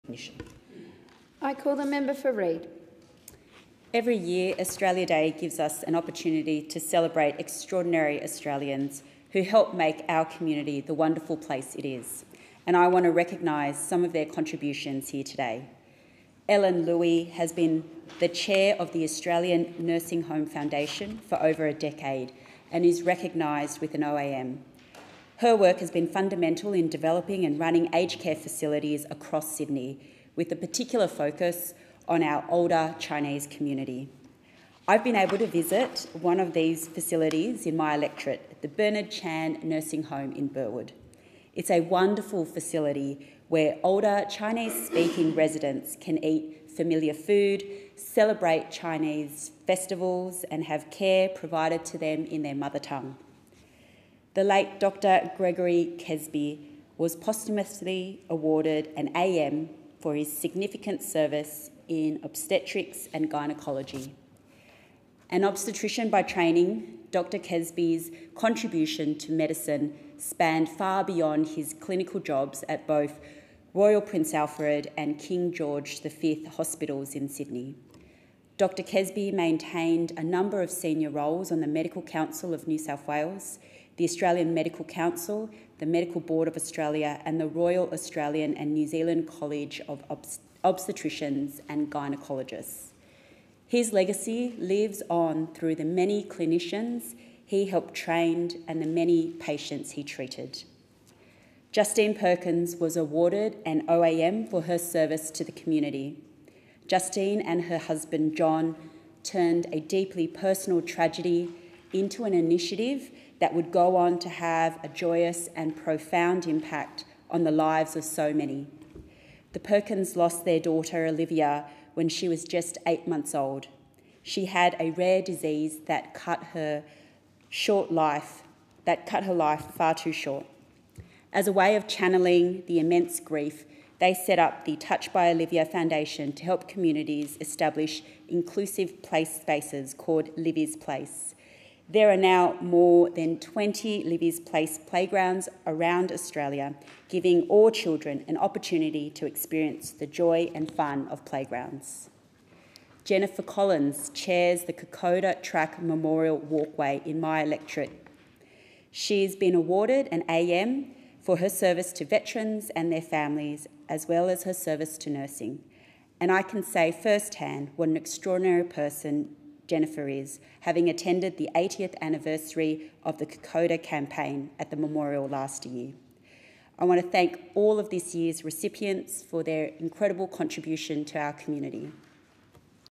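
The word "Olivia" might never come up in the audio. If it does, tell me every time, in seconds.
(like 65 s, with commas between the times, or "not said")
121 s, 135 s.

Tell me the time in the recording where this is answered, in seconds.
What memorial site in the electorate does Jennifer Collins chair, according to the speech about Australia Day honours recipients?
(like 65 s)
154 s.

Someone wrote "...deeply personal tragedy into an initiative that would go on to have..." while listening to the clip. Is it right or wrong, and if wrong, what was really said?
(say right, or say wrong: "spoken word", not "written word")
right.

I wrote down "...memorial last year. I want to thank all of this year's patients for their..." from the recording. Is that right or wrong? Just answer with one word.
wrong.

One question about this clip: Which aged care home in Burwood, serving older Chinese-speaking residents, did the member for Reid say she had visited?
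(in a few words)
Bernard Chan Nursing Home.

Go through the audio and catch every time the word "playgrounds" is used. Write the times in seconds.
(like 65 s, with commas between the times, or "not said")
144 s, 151 s.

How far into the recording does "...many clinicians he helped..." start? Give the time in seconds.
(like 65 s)
95 s.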